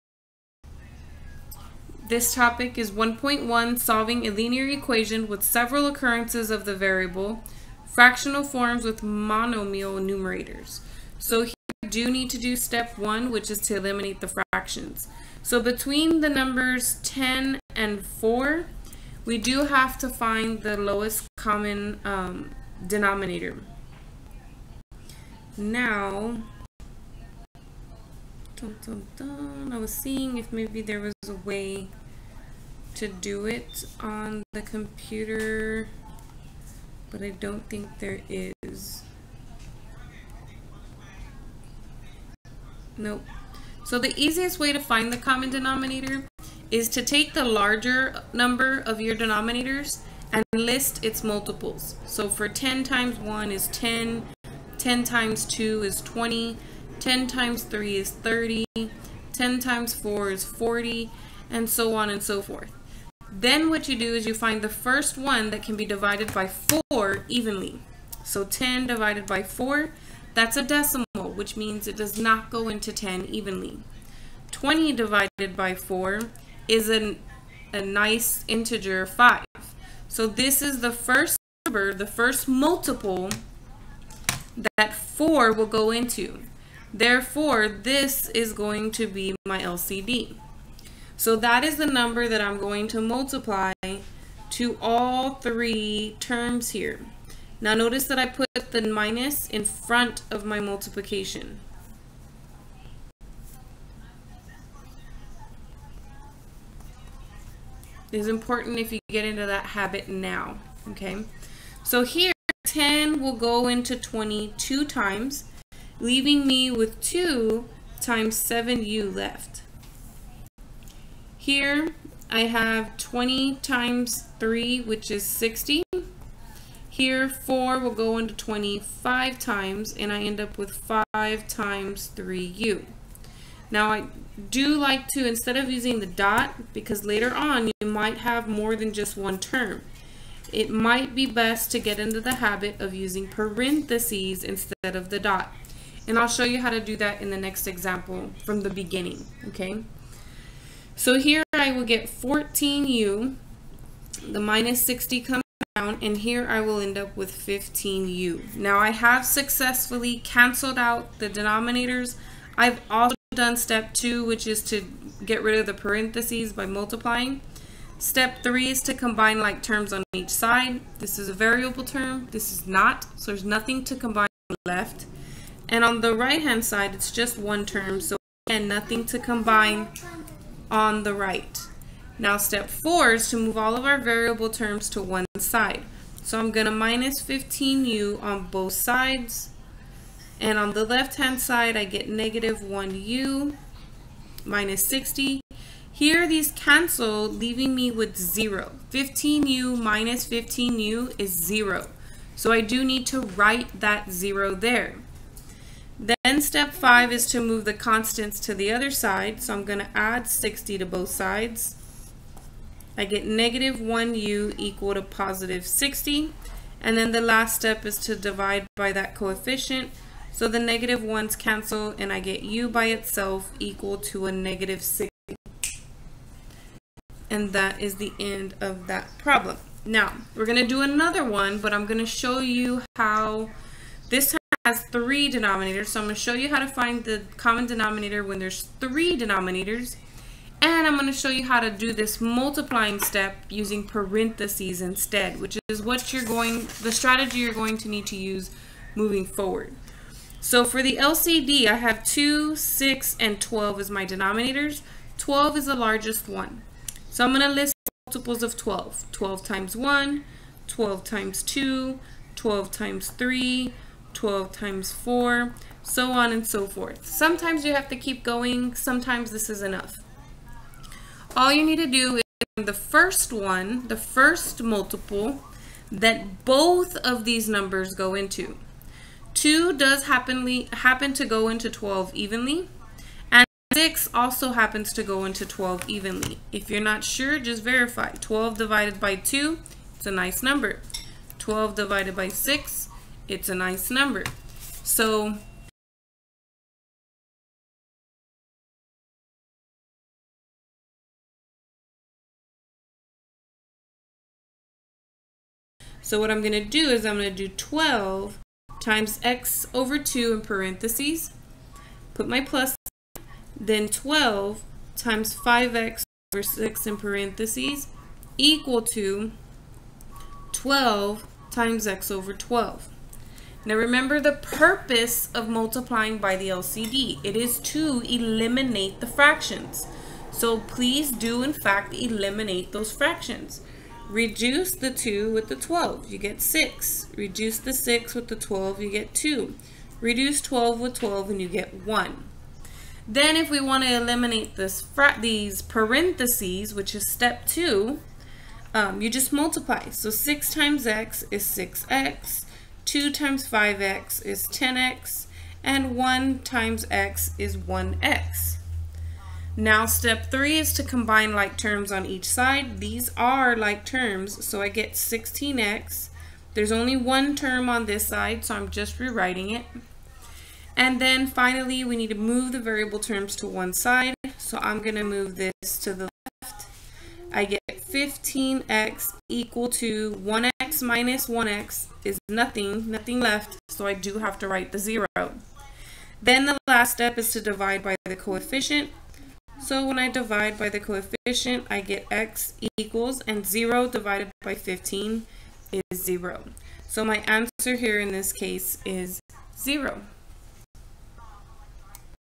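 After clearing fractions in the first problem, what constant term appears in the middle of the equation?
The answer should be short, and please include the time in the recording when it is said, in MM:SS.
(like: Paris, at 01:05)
60, at 02:04.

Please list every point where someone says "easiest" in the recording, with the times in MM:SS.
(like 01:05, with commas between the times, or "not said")
00:44.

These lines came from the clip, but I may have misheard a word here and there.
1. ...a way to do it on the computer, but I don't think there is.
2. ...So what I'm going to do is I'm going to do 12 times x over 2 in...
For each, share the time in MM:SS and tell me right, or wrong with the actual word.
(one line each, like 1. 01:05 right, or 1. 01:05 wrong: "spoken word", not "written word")
1. 00:31 right
2. 05:06 right.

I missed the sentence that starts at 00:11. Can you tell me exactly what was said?
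So here we do need to do step one, which is to eliminate the fractions.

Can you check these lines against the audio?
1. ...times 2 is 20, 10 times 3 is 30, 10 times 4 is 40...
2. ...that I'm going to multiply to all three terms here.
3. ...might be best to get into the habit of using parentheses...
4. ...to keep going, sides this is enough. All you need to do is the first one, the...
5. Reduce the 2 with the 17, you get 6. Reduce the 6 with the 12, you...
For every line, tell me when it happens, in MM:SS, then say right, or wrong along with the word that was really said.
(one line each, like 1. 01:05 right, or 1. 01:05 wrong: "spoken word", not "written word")
1. 00:55 right
2. 01:32 right
3. 02:20 right
4. 04:27 wrong: "sometimes", not "sides"
5. 05:34 wrong: "12", not "17".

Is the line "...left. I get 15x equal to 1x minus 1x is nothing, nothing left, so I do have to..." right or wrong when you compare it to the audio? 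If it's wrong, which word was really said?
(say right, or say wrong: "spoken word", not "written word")
right.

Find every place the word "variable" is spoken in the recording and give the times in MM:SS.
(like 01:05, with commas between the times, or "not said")
00:06, 02:51, 03:03, 06:12.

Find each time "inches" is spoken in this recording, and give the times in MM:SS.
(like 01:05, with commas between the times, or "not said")
not said.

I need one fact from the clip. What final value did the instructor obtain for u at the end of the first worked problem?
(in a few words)
-60.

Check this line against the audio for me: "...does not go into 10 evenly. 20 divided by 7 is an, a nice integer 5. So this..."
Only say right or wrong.
wrong.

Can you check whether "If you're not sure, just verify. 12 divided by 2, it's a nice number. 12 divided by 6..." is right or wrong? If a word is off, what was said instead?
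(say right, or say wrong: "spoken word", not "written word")
right.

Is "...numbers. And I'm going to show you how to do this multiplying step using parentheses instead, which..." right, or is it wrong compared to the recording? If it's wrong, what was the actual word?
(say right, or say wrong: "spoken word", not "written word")
wrong: "denominators", not "numbers".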